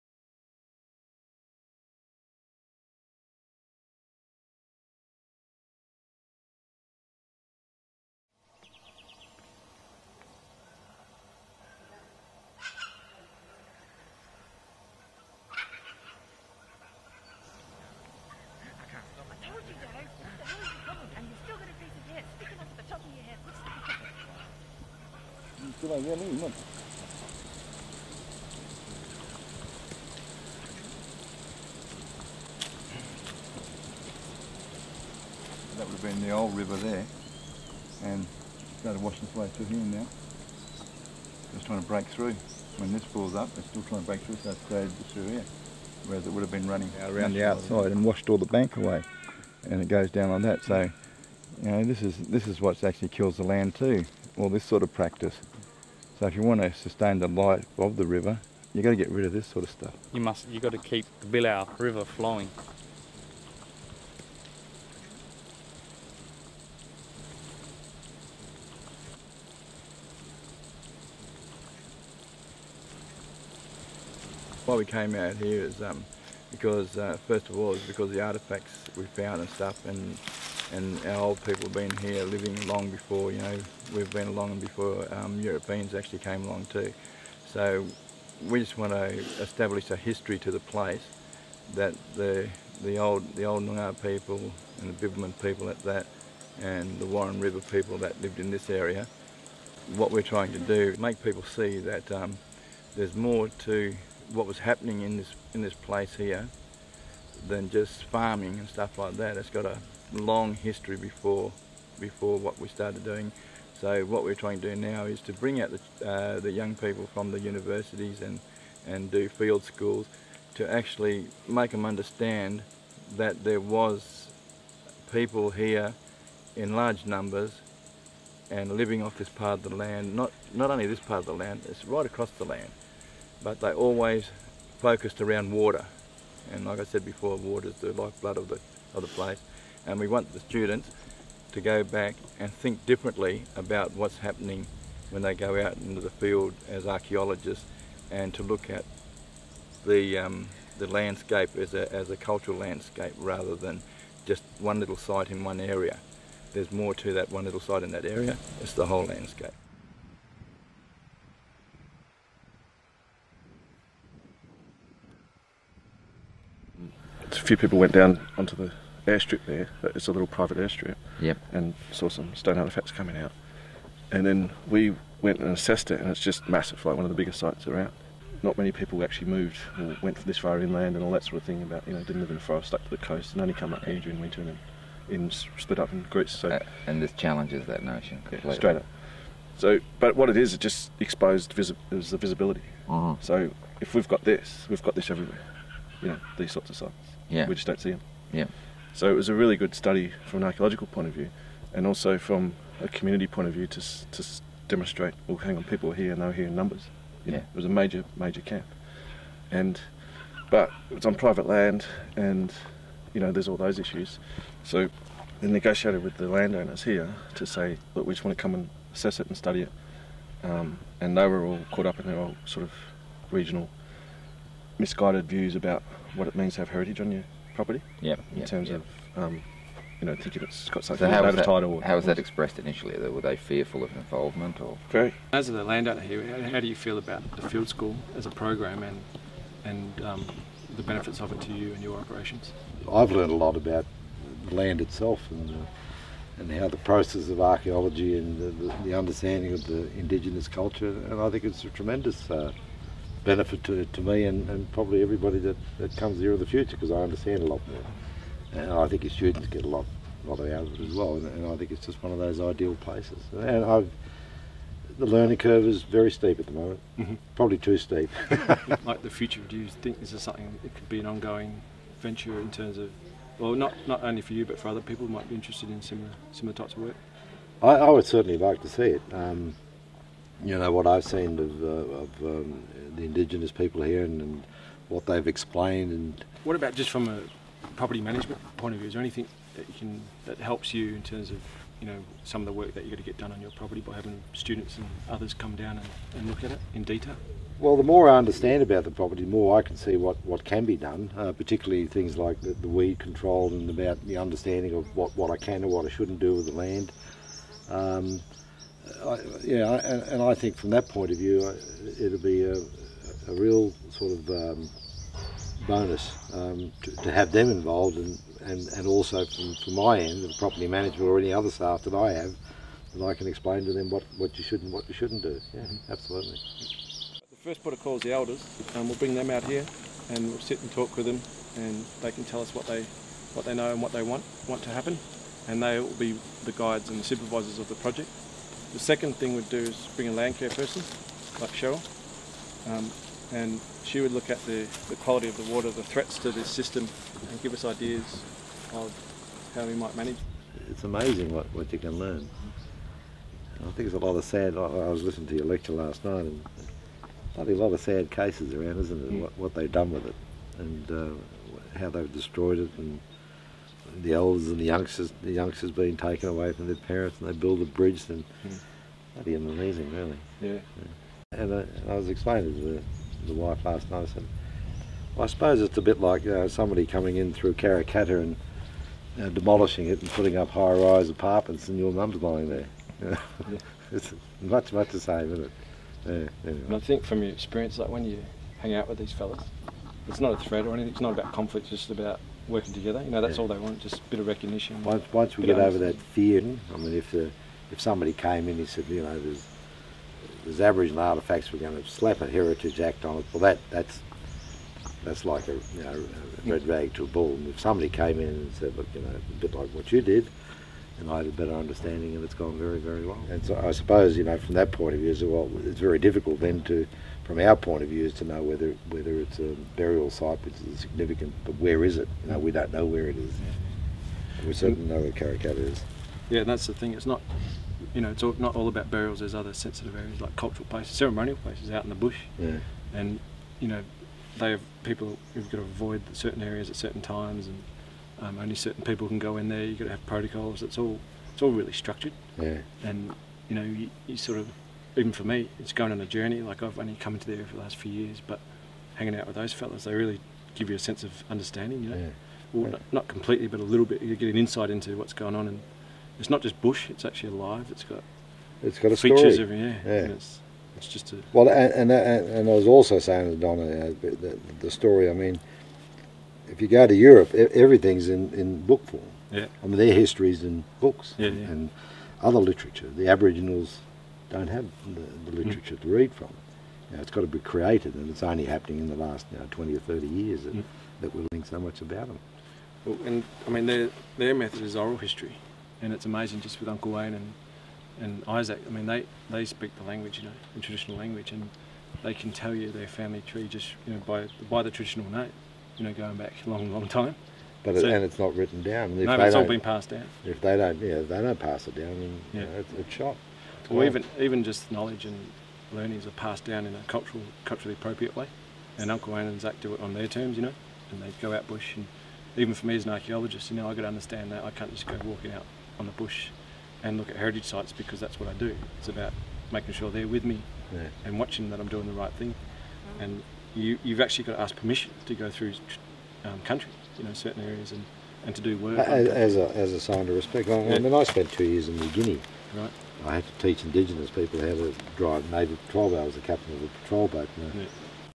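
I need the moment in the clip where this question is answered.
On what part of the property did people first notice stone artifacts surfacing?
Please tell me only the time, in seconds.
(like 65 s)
170 s.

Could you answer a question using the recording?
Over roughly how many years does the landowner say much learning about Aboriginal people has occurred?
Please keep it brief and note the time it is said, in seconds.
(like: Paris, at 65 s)
20 or 30 years, at 479 s.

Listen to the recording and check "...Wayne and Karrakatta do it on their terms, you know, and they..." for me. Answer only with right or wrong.
wrong.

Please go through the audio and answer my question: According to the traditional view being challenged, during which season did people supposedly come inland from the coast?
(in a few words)
Winter.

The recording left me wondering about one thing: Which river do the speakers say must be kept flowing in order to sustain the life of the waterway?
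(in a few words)
Billau River.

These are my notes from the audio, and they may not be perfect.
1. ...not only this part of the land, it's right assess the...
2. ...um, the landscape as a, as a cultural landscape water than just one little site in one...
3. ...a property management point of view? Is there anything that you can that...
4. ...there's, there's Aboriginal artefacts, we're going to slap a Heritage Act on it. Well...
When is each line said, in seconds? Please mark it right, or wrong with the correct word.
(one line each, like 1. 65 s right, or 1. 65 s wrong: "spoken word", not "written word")
1. 130 s wrong: "across", not "assess"
2. 150 s wrong: "rather", not "water"
3. 287 s right
4. 399 s right.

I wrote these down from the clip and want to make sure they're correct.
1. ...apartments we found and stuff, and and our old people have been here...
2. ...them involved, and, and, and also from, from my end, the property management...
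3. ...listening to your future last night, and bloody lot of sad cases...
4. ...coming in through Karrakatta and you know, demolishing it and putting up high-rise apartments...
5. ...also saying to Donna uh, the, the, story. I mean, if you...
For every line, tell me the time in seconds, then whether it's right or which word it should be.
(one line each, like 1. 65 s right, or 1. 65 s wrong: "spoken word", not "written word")
1. 78 s wrong: "artefacts", not "apartments"
2. 317 s right
3. 355 s wrong: "lecture", not "future"
4. 376 s right
5. 462 s right.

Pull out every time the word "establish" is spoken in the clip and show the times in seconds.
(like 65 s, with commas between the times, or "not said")
89 s.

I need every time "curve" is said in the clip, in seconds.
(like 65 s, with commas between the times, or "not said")
265 s.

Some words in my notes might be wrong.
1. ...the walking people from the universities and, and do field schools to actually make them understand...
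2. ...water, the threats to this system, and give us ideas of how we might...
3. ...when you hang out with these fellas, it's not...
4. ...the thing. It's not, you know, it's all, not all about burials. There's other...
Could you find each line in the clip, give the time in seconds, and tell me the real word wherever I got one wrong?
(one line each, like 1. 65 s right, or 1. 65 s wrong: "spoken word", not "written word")
1. 116 s wrong: "young", not "walking"
2. 345 s right
3. 387 s right
4. 426 s right.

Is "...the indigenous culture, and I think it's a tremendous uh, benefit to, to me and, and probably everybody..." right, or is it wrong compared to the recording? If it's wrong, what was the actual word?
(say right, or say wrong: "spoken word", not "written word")
right.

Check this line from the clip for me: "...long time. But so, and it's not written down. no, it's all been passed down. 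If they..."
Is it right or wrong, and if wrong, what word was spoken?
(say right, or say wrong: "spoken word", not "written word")
right.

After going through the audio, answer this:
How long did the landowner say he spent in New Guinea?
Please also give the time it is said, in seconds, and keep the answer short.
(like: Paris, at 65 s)
2 years, at 531 s.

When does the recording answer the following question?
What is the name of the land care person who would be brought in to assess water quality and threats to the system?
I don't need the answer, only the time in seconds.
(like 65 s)
341 s.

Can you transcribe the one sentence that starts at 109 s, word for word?
It's got a long history before before what we started doing.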